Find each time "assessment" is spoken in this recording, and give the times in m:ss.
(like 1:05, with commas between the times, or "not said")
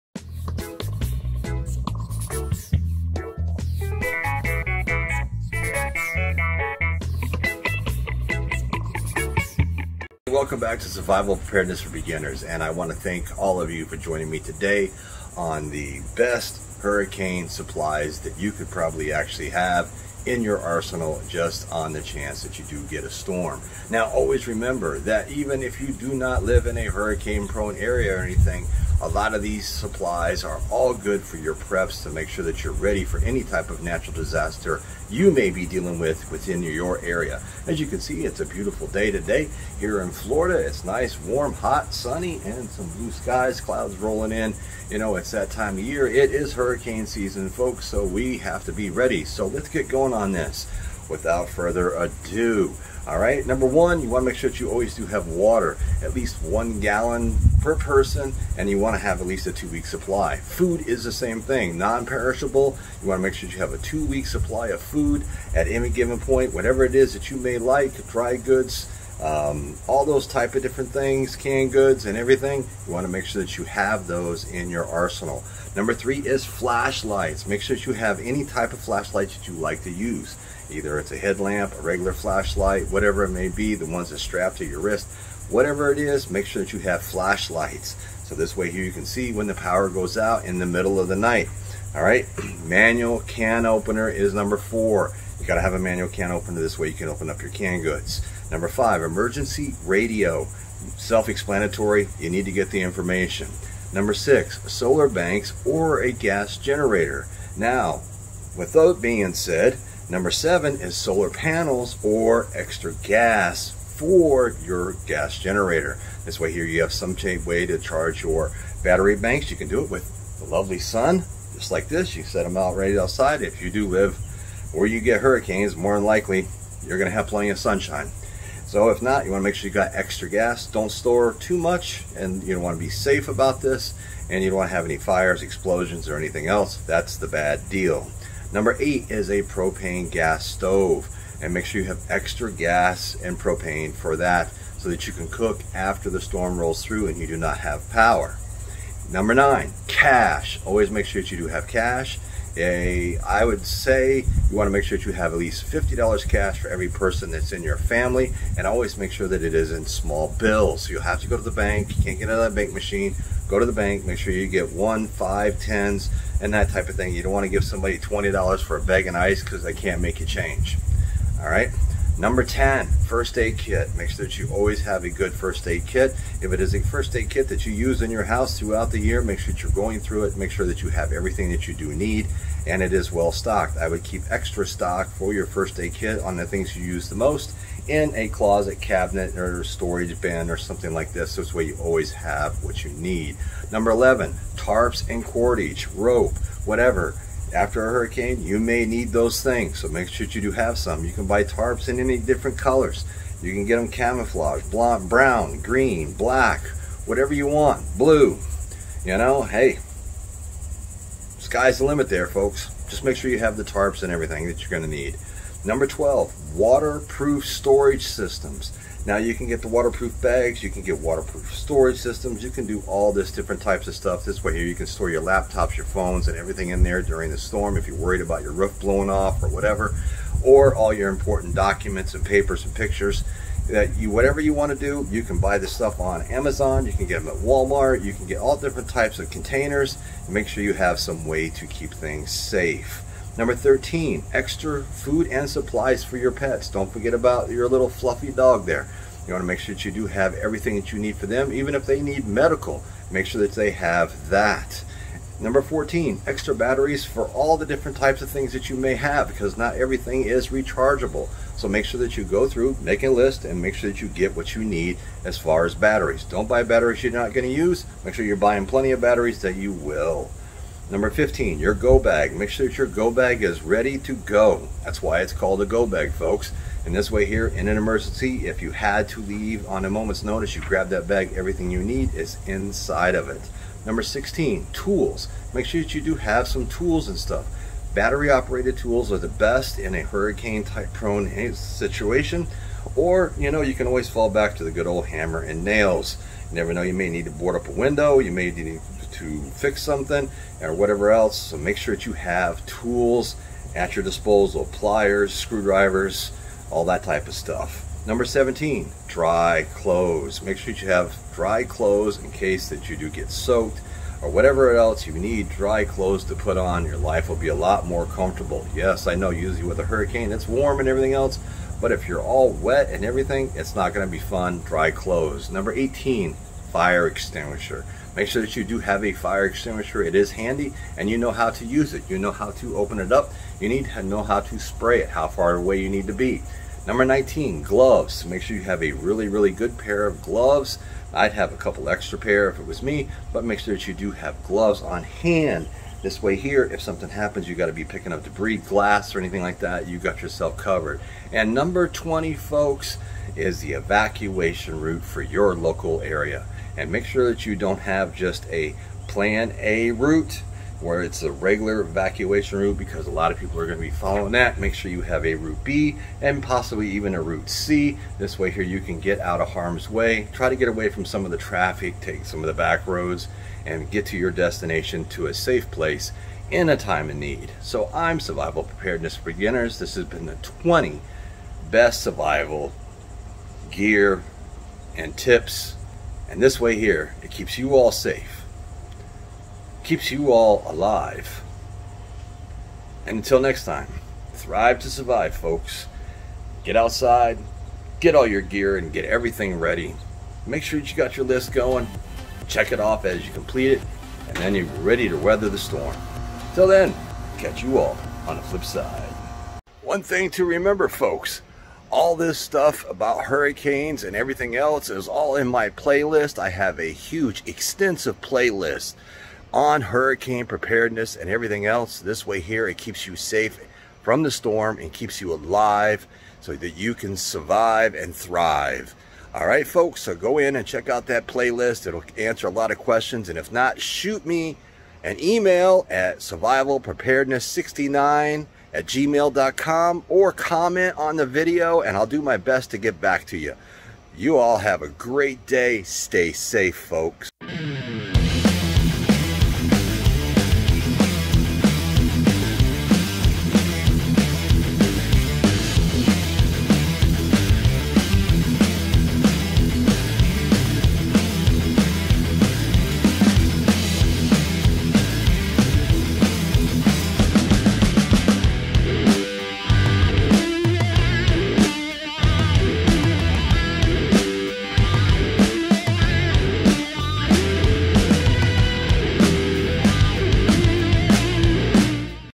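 not said.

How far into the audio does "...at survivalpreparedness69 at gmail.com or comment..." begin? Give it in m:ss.
7:15.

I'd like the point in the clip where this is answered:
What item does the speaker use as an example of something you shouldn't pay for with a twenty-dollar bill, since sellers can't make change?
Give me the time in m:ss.
2:48.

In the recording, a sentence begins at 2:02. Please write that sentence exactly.
You set them out right outside.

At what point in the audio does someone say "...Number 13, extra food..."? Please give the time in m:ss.
4:03.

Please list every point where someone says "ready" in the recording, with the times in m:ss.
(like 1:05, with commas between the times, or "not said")
0:32, 0:48, 4:33, 6:39, 6:44.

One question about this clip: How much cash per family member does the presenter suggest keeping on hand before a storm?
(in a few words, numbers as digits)
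$50.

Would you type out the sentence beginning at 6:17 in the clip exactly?
So I'm Survival Preparedness for Beginners.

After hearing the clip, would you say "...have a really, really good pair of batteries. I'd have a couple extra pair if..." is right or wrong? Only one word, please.
wrong.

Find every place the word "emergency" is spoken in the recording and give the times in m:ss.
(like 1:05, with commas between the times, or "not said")
1:39, 4:37.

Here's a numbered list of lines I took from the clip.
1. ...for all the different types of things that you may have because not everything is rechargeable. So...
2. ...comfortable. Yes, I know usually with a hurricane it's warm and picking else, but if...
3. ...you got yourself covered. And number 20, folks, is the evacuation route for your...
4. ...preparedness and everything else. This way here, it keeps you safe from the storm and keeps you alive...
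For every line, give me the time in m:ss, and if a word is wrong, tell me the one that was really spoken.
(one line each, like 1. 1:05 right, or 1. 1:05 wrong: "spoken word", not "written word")
1. 4:17 right
2. 5:18 wrong: "everything", not "picking"
3. 5:49 right
4. 7:00 right.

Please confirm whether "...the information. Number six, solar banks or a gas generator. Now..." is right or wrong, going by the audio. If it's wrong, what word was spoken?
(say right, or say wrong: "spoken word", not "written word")
right.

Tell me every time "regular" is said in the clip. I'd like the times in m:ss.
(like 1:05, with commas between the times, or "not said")
1:21, 6:01.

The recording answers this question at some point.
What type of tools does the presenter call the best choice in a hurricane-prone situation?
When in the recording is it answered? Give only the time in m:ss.
4:47.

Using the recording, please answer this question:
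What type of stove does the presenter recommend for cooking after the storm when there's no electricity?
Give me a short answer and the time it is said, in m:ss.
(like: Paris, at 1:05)
Propane gas stove, at 2:19.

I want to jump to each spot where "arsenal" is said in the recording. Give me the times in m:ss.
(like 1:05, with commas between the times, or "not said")
0:20, 1:14.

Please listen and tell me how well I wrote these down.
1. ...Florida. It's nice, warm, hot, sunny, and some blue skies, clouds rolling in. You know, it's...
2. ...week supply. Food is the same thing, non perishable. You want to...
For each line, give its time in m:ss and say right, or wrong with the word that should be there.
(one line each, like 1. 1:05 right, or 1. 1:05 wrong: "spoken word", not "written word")
1. 0:40 right
2. 0:59 right.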